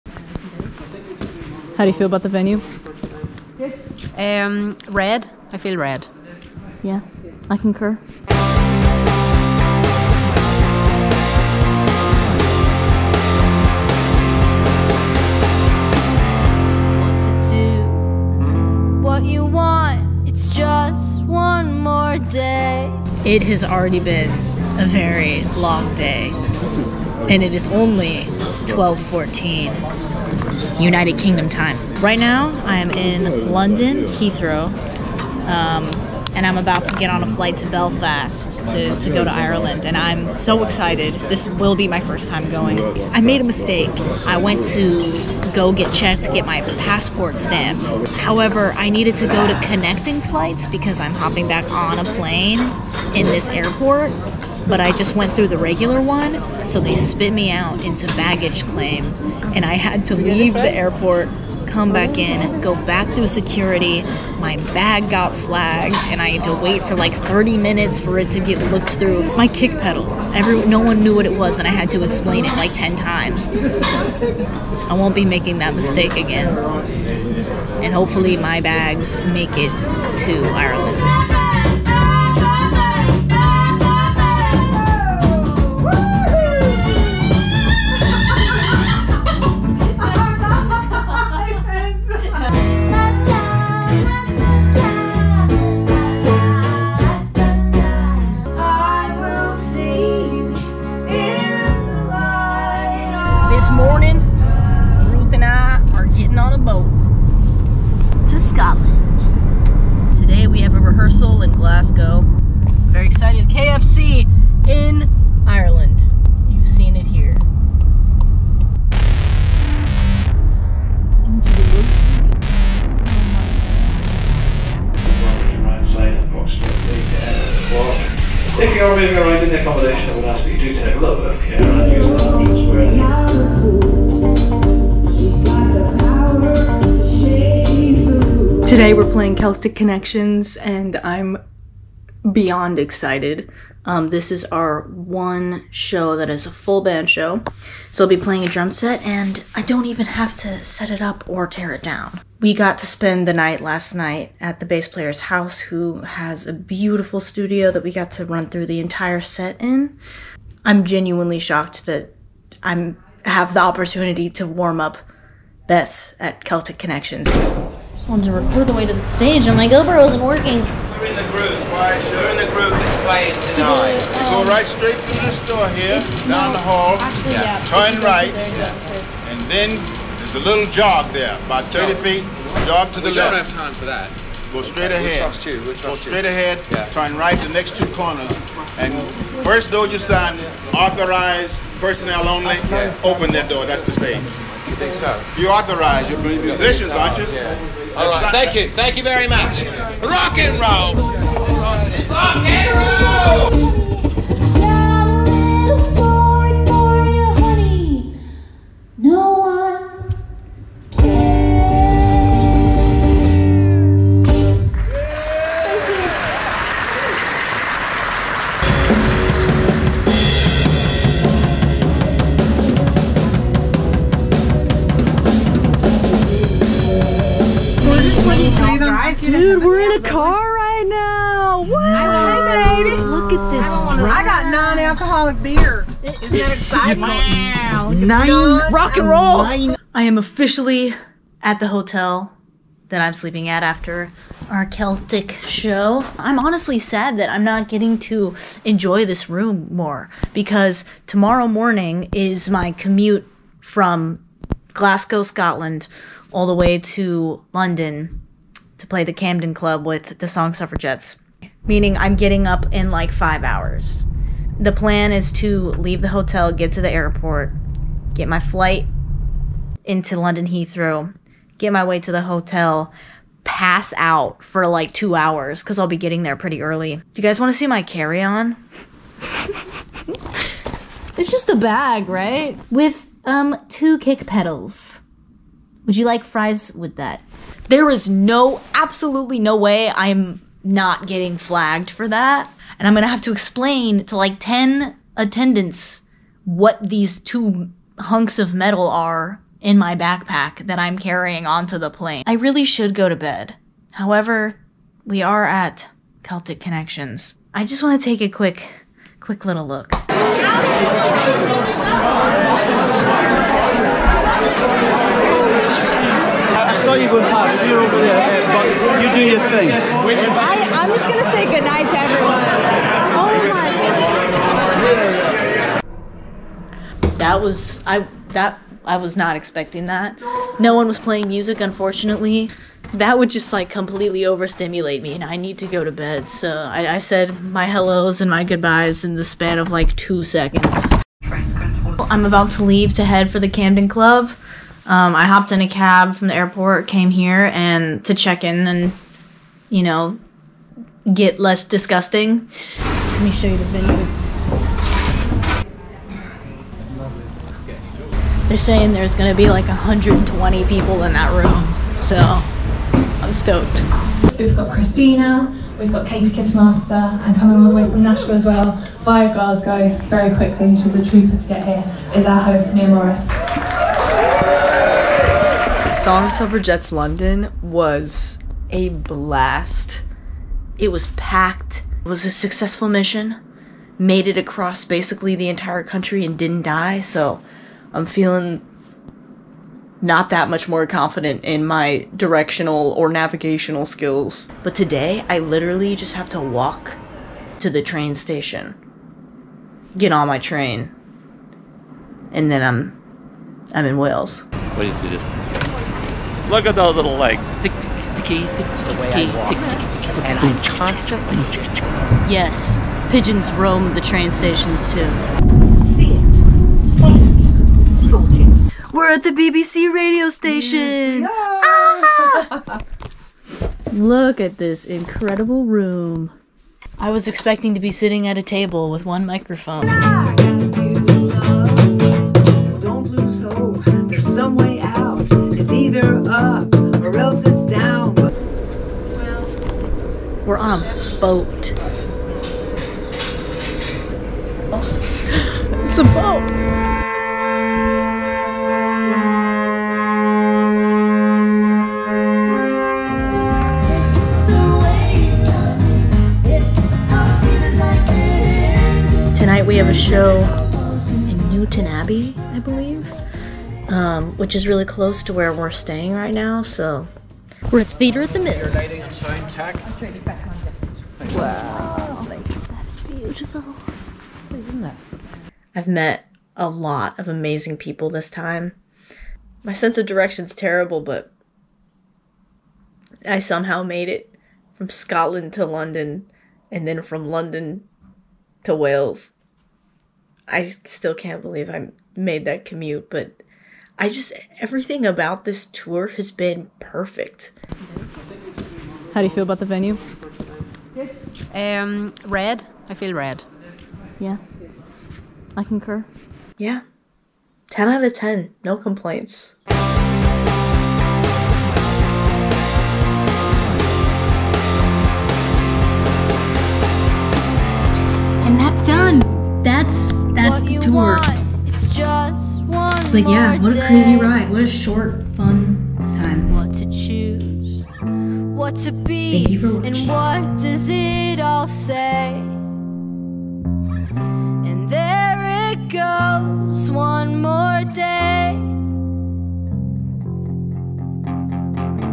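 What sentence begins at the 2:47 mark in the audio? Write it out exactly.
Just wanted to record the way to the stage, and my GoPro isn't working you are in the group.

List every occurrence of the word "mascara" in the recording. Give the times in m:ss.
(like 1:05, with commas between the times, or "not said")
not said.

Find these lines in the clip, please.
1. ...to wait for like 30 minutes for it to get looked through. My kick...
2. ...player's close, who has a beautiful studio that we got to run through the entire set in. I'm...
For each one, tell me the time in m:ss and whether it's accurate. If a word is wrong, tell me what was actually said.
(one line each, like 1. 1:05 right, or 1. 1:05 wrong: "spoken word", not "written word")
1. 1:06 right
2. 2:34 wrong: "house", not "close".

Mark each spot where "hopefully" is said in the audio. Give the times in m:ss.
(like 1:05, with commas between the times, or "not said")
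1:17.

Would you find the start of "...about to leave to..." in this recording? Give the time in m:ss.
5:42.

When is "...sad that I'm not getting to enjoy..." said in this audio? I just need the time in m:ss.
4:06.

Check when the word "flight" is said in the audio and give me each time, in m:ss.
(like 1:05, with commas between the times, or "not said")
0:37, 0:50, 4:28.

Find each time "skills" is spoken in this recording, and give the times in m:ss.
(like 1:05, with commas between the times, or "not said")
6:33.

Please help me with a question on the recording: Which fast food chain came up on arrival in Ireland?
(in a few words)
KFC.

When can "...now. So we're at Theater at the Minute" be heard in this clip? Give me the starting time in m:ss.
7:46.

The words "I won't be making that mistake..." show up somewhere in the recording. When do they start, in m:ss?
1:13.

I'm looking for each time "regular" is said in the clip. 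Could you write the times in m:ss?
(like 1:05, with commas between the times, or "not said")
0:55.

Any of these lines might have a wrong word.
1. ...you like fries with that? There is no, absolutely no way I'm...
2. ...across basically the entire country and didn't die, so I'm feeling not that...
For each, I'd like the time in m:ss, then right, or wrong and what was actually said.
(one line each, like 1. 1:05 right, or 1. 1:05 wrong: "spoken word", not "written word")
1. 4:45 right
2. 6:24 right.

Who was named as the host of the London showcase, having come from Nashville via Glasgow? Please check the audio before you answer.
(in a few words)
Mia Morris.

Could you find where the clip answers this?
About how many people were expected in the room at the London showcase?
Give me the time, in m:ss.
5:59.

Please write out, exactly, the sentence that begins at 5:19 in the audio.
I, I'm just gonna say goodnight to everyone.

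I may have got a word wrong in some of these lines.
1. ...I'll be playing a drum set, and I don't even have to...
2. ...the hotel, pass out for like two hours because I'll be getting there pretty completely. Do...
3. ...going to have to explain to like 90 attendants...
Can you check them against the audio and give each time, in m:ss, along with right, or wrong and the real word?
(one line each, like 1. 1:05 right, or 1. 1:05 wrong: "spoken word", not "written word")
1. 2:28 right
2. 4:32 wrong: "early", not "completely"
3. 4:52 wrong: "10", not "90".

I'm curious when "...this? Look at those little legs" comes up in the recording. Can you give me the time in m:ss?
6:45.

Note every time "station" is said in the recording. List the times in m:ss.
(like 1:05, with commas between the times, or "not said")
6:38, 6:54, 7:00.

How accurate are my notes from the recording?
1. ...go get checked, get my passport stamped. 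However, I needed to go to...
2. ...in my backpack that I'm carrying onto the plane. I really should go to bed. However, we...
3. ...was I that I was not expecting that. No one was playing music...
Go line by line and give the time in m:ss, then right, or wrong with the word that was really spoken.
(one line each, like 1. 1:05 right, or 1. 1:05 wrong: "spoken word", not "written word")
1. 0:45 right
2. 4:59 right
3. 5:27 right.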